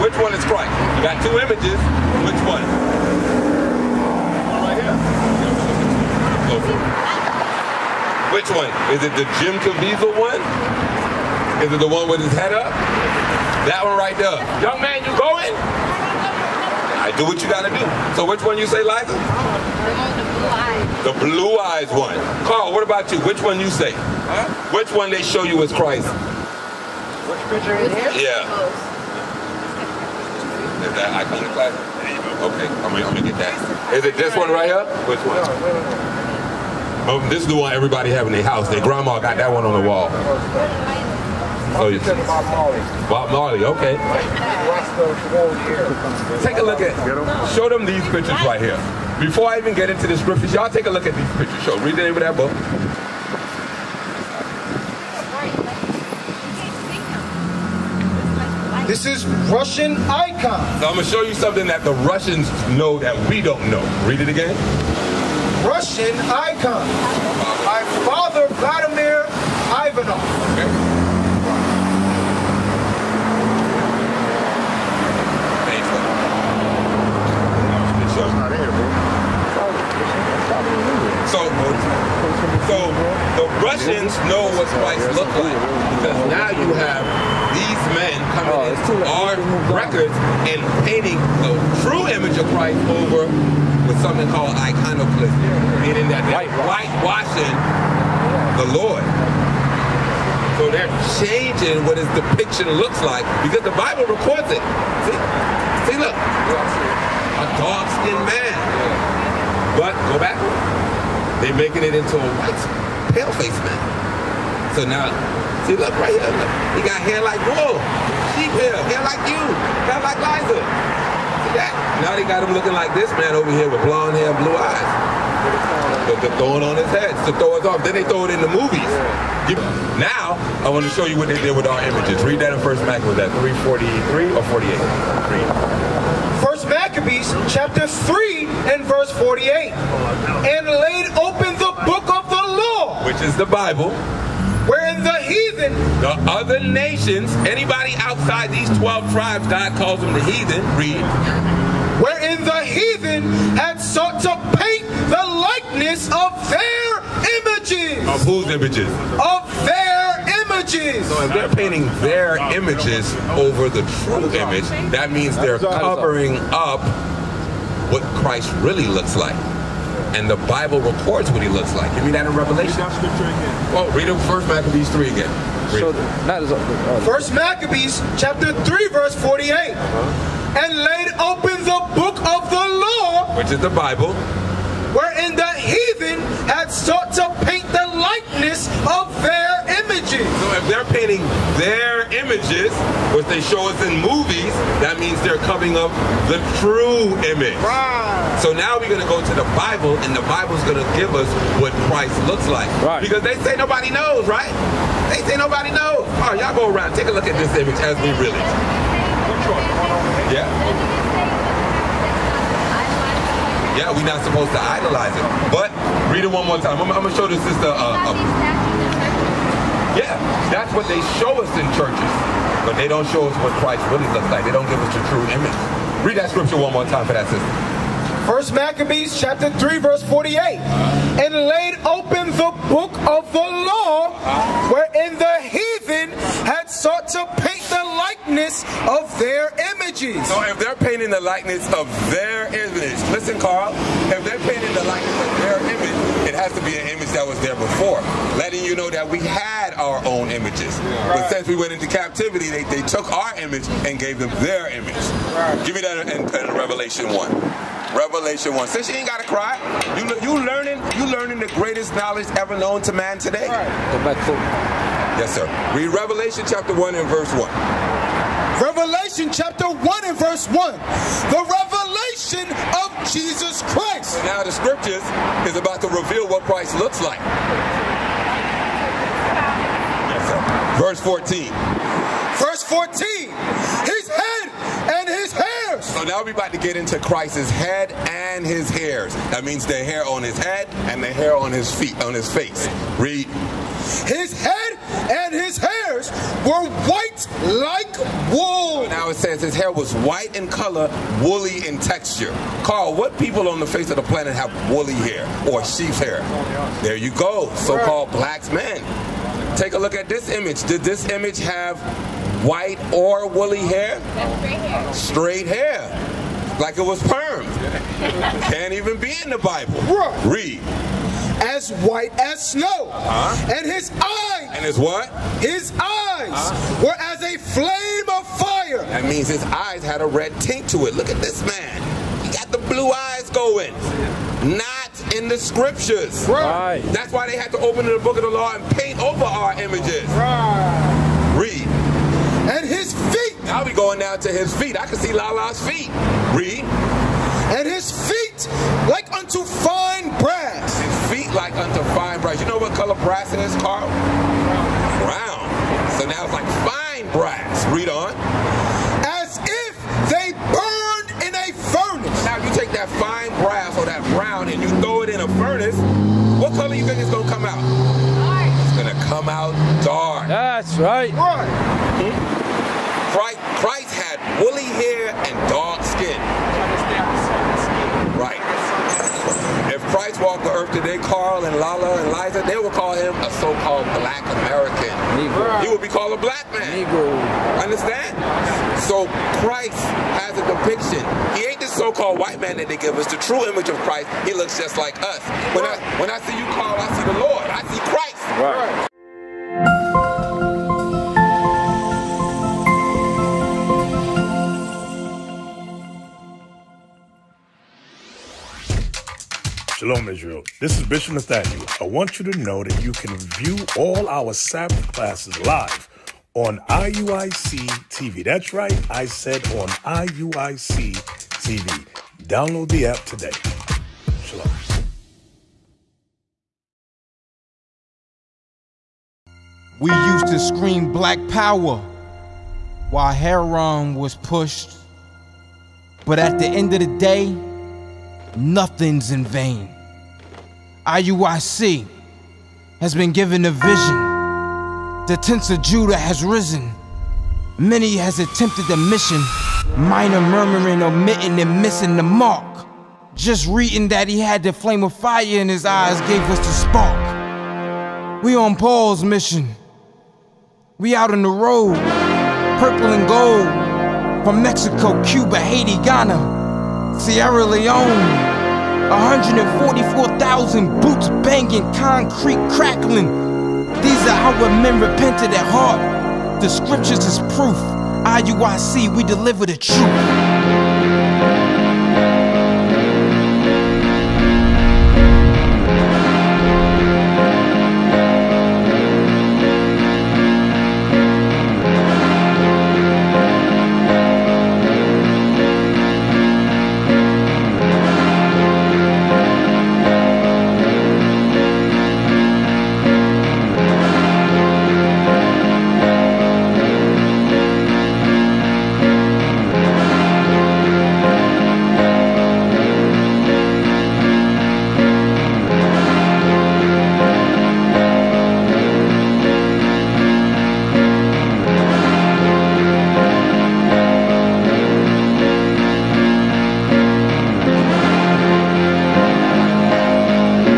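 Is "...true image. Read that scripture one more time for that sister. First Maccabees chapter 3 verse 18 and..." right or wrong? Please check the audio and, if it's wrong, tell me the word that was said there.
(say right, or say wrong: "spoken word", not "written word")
wrong: "48", not "18".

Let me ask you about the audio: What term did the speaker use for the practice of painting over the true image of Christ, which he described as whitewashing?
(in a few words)
iconoclasm.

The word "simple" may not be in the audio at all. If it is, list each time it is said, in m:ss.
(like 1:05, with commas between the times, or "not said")
not said.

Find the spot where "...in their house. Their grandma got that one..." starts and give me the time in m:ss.
0:38.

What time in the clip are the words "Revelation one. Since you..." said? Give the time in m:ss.
4:17.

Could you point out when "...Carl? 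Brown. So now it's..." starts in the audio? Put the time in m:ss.
5:53.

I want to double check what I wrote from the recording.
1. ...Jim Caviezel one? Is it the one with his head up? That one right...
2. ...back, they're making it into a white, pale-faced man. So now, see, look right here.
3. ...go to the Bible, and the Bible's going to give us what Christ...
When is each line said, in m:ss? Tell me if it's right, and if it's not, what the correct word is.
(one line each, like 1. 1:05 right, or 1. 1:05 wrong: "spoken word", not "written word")
1. 0:09 right
2. 1:50 right
3. 3:19 right.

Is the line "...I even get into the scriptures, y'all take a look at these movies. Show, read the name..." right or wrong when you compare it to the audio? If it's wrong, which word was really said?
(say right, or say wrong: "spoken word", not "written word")
wrong: "pictures", not "movies".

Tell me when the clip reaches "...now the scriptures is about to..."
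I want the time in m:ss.
4:34.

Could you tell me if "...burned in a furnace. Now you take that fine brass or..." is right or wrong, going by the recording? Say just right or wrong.
right.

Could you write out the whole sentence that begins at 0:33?
Is it this one right here?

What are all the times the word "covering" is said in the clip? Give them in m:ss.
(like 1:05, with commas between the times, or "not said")
2:45, 3:15.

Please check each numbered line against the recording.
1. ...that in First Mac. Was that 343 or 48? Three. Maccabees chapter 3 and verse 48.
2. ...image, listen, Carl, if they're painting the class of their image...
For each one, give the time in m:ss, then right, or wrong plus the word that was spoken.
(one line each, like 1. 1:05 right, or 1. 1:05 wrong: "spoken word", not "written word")
1. 2:12 right
2. 4:02 wrong: "likeness", not "class".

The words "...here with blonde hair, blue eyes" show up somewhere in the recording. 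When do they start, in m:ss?
2:03.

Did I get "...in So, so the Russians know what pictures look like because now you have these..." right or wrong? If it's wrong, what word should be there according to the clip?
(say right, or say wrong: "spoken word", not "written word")
wrong: "whites", not "pictures".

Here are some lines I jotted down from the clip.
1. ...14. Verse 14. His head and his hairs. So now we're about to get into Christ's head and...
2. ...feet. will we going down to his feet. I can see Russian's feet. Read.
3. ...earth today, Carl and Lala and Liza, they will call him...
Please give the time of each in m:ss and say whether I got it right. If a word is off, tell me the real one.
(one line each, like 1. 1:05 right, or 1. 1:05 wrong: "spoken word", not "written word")
1. 4:40 right
2. 5:43 wrong: "Lala", not "Russian"
3. 6:20 right.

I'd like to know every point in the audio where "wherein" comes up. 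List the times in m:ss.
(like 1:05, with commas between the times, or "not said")
2:24, 2:32, 3:04, 3:54.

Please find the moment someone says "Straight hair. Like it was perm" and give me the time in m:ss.
5:14.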